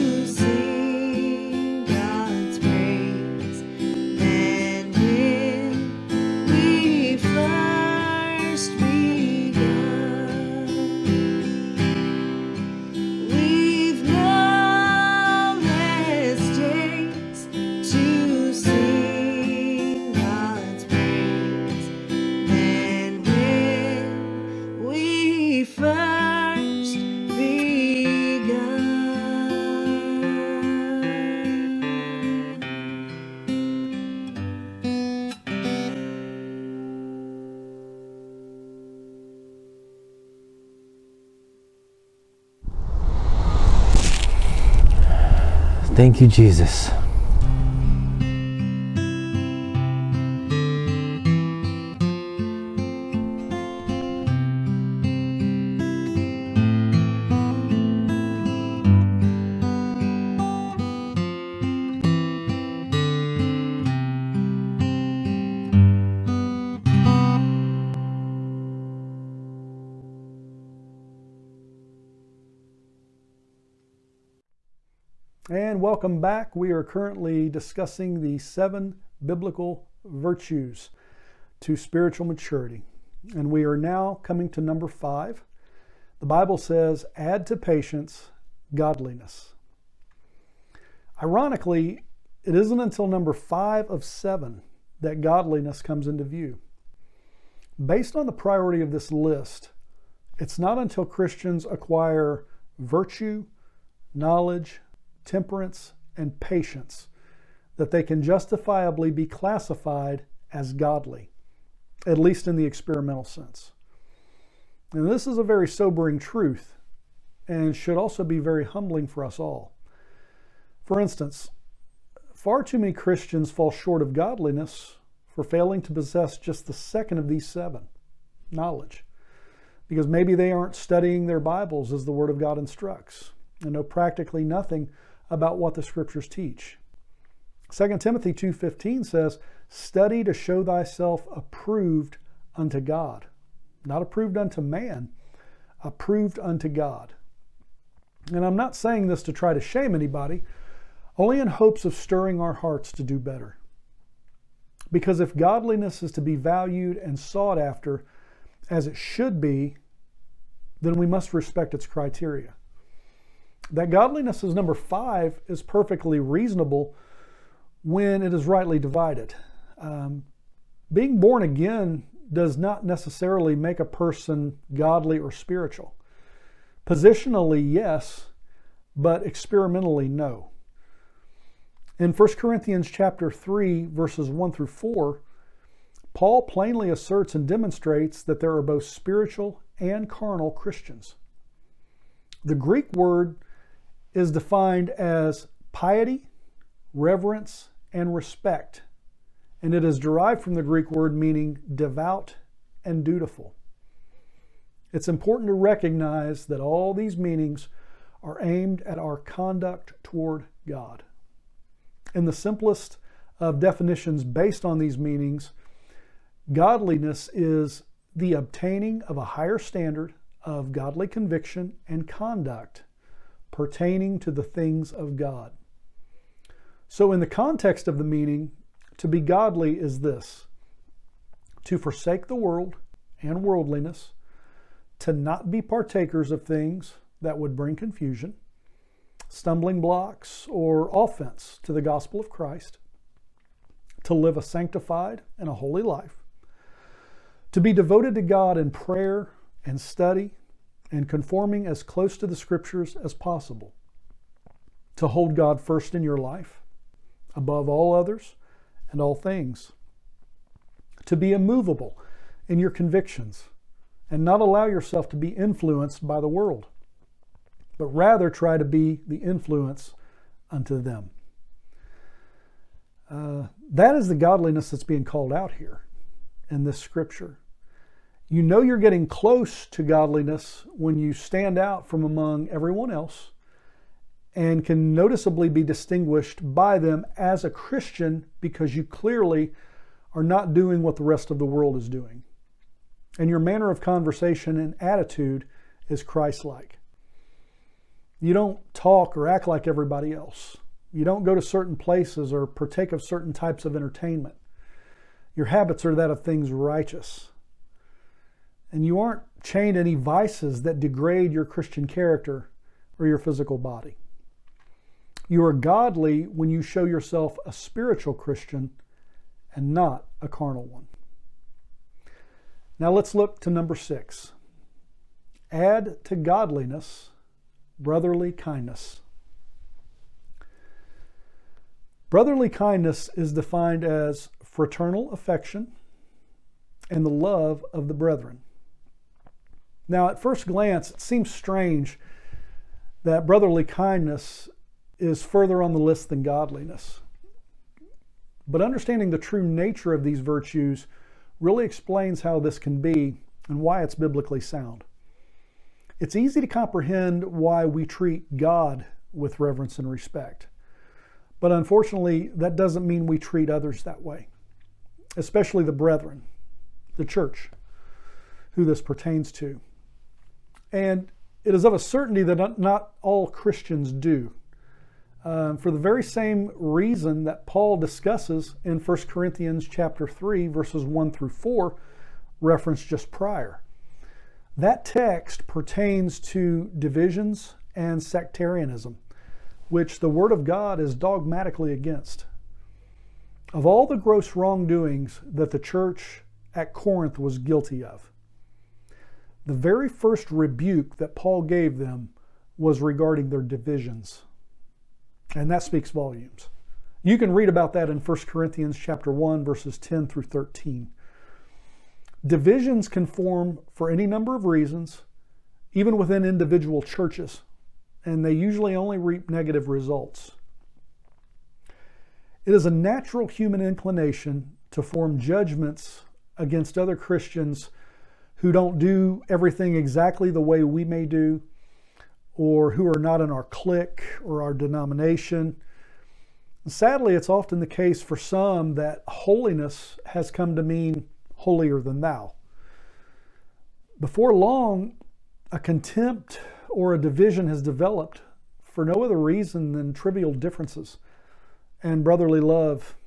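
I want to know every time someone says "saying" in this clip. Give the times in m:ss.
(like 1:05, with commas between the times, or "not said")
2:28.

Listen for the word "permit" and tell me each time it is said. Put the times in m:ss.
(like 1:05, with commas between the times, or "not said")
not said.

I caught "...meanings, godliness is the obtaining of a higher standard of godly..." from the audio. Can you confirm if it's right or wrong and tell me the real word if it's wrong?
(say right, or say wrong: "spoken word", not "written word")
right.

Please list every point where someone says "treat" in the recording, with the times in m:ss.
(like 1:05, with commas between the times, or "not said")
5:57, 6:03.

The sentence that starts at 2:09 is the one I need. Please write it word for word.
Because maybe they aren't studying their Bibles as the Word of God instructs and know practically nothing about what the scriptures teach.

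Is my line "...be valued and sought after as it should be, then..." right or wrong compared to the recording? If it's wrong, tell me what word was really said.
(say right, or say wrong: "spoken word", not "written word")
right.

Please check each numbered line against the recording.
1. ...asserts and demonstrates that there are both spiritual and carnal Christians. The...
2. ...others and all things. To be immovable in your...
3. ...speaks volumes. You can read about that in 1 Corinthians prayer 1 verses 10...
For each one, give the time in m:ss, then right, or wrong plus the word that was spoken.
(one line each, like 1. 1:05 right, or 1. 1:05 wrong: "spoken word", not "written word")
1. 3:06 right
2. 4:17 right
3. 6:45 wrong: "chapter", not "prayer".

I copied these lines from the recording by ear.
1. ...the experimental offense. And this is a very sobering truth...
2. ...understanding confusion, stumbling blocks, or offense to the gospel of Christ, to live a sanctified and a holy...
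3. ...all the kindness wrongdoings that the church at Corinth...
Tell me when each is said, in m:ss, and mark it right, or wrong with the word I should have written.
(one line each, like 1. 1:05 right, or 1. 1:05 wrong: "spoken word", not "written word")
1. 1:52 wrong: "sense", not "offense"
2. 3:57 wrong: "bring", not "understanding"
3. 6:33 wrong: "gross", not "kindness".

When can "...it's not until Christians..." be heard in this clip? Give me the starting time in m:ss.
1:40.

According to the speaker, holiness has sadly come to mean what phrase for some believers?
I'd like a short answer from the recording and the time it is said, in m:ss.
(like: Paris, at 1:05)
holier than thou, at 7:21.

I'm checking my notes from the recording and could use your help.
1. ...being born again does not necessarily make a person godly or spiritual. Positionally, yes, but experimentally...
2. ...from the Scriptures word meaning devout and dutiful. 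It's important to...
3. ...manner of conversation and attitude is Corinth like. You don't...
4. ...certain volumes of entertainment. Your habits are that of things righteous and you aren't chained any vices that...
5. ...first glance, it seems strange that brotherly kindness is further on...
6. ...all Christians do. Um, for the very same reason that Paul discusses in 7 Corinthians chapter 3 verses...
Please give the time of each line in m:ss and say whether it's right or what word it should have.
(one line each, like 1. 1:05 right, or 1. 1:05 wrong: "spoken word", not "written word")
1. 2:50 right
2. 3:20 wrong: "Greek", not "Scriptures"
3. 4:53 wrong: "Christ", not "Corinth"
4. 5:03 wrong: "types", not "volumes"
5. 5:40 right
6. 6:13 wrong: "1", not "7".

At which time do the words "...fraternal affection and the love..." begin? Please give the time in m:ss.
5:34.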